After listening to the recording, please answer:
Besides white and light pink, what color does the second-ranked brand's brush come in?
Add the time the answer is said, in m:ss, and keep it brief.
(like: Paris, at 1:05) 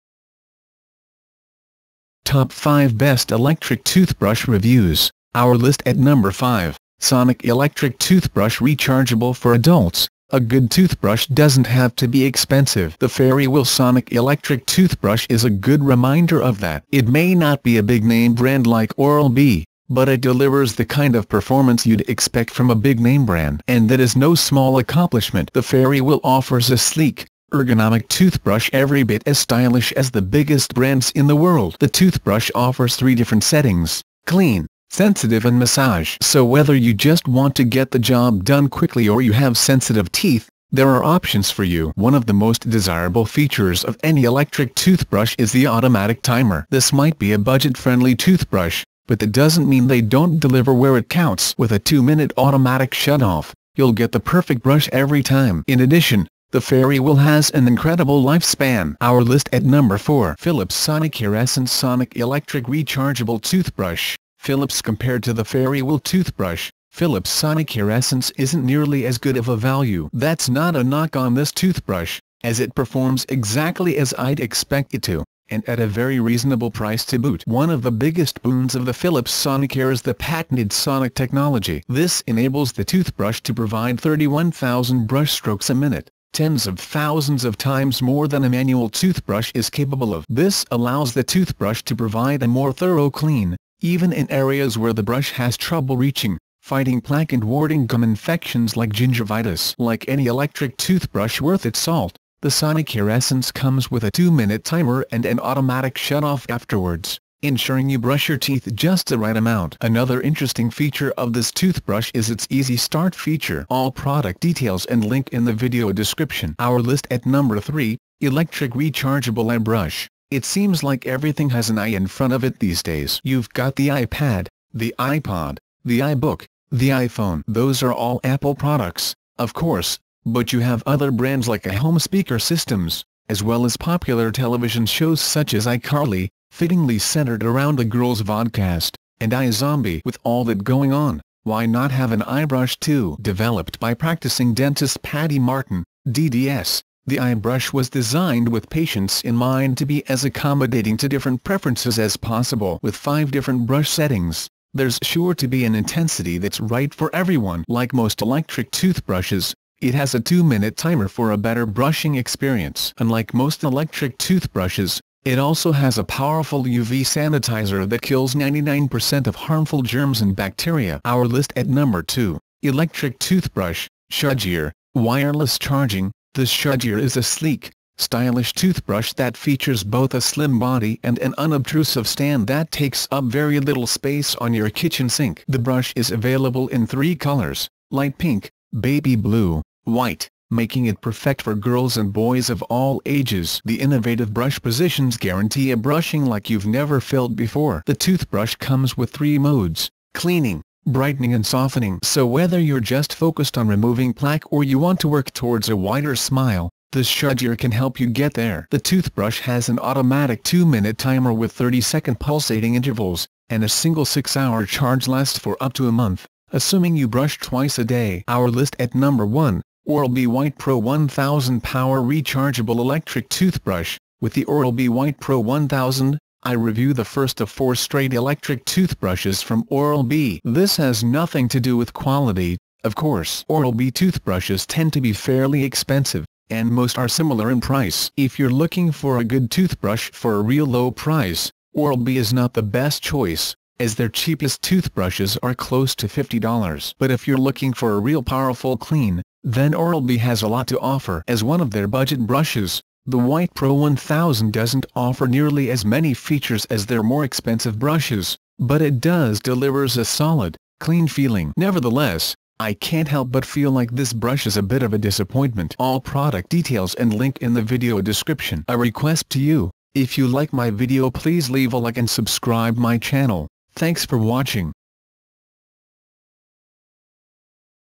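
Baby blue, at 3:08.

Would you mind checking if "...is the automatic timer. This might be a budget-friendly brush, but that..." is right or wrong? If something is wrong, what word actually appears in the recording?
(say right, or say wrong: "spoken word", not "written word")
wrong: "toothbrush", not "brush".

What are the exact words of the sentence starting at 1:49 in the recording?
Another interesting feature of this toothbrush is its Easy Start feature.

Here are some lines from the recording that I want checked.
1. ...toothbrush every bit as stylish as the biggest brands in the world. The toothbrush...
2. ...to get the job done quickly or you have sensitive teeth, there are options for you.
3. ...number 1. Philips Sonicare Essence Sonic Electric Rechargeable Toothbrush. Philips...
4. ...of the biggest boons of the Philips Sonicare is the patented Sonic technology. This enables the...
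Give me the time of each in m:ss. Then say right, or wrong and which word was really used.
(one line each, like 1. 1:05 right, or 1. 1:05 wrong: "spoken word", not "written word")
1. 0:28 right
2. 0:37 right
3. 0:59 wrong: "4", not "1"
4. 1:17 right.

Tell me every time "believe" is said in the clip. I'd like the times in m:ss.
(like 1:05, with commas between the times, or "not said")
not said.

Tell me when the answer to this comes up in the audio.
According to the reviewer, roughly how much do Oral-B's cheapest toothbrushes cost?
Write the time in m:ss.
4:06.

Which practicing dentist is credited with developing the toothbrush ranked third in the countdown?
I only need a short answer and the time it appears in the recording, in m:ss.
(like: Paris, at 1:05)
Patty Martin, at 2:25.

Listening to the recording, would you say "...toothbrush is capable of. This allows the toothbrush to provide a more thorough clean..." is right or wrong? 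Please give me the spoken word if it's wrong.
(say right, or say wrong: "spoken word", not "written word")
right.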